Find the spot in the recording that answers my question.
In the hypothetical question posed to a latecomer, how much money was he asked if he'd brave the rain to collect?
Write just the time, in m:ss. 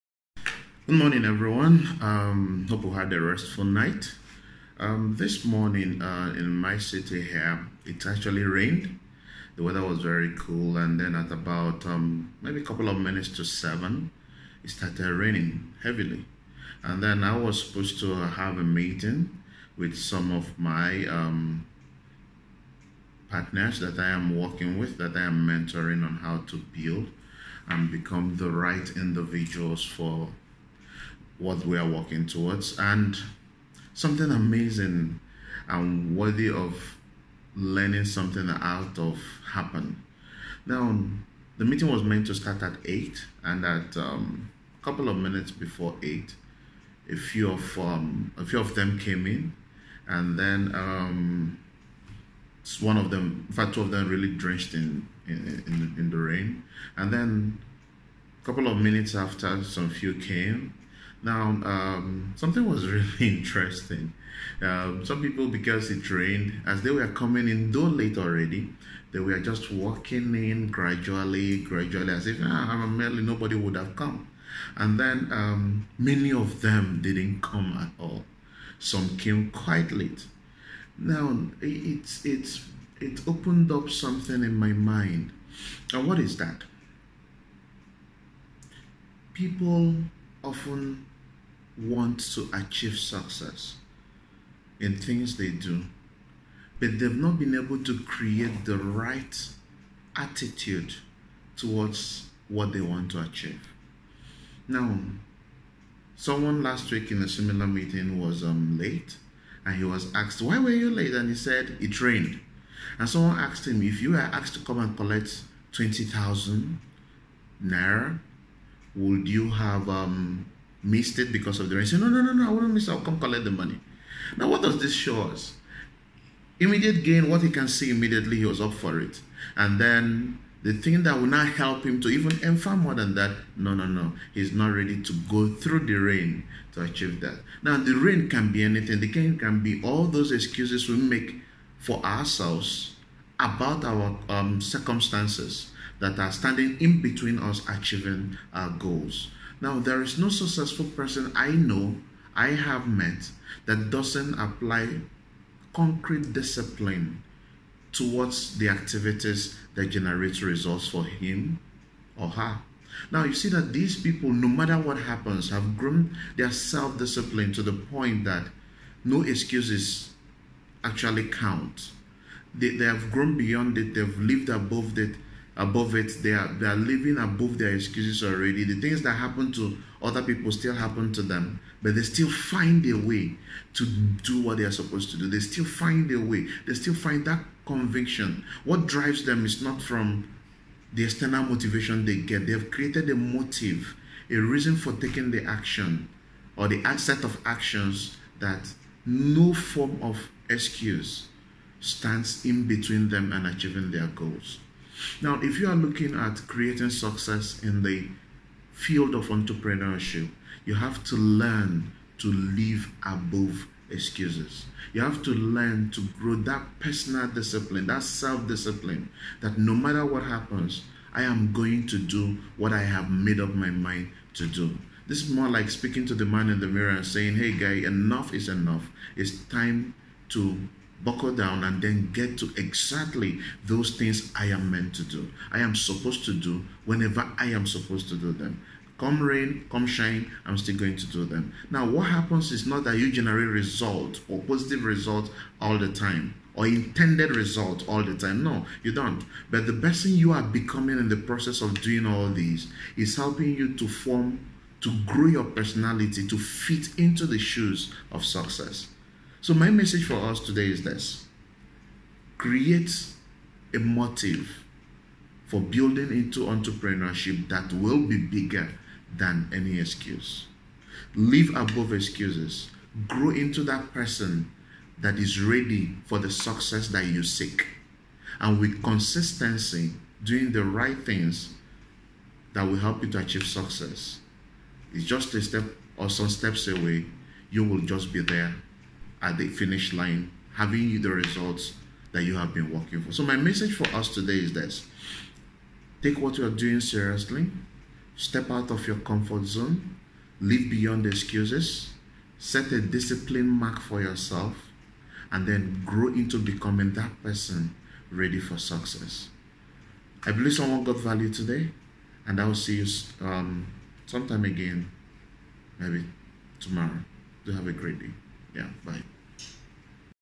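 1:55.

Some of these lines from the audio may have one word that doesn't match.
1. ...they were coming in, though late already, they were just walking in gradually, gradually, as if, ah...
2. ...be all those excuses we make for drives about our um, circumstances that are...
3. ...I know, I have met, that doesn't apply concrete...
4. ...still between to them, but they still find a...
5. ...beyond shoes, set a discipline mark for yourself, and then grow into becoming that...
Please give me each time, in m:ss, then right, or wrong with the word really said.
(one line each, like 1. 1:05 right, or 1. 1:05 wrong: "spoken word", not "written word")
1. 1:06 right
2. 2:19 wrong: "ourselves", not "drives"
3. 2:31 right
4. 3:00 wrong: "happen", not "between"
5. 5:00 wrong: "excuses", not "shoes".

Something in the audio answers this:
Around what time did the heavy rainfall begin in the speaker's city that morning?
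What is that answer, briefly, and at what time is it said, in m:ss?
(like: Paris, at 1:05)
a couple of minutes to seven, at 0:12.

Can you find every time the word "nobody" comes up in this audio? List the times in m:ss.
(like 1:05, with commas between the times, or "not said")
1:13.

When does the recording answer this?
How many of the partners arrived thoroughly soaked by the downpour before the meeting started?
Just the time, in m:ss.
0:53.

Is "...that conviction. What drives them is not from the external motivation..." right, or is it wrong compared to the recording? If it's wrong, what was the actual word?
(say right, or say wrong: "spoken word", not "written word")
right.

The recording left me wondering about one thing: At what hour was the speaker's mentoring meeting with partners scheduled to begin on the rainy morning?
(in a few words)
8.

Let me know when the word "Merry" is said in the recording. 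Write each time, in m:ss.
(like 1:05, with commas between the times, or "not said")
not said.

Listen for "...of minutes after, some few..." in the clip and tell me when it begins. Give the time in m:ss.
0:58.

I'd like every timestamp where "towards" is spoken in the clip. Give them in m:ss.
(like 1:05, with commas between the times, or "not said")
0:32, 1:41, 2:37.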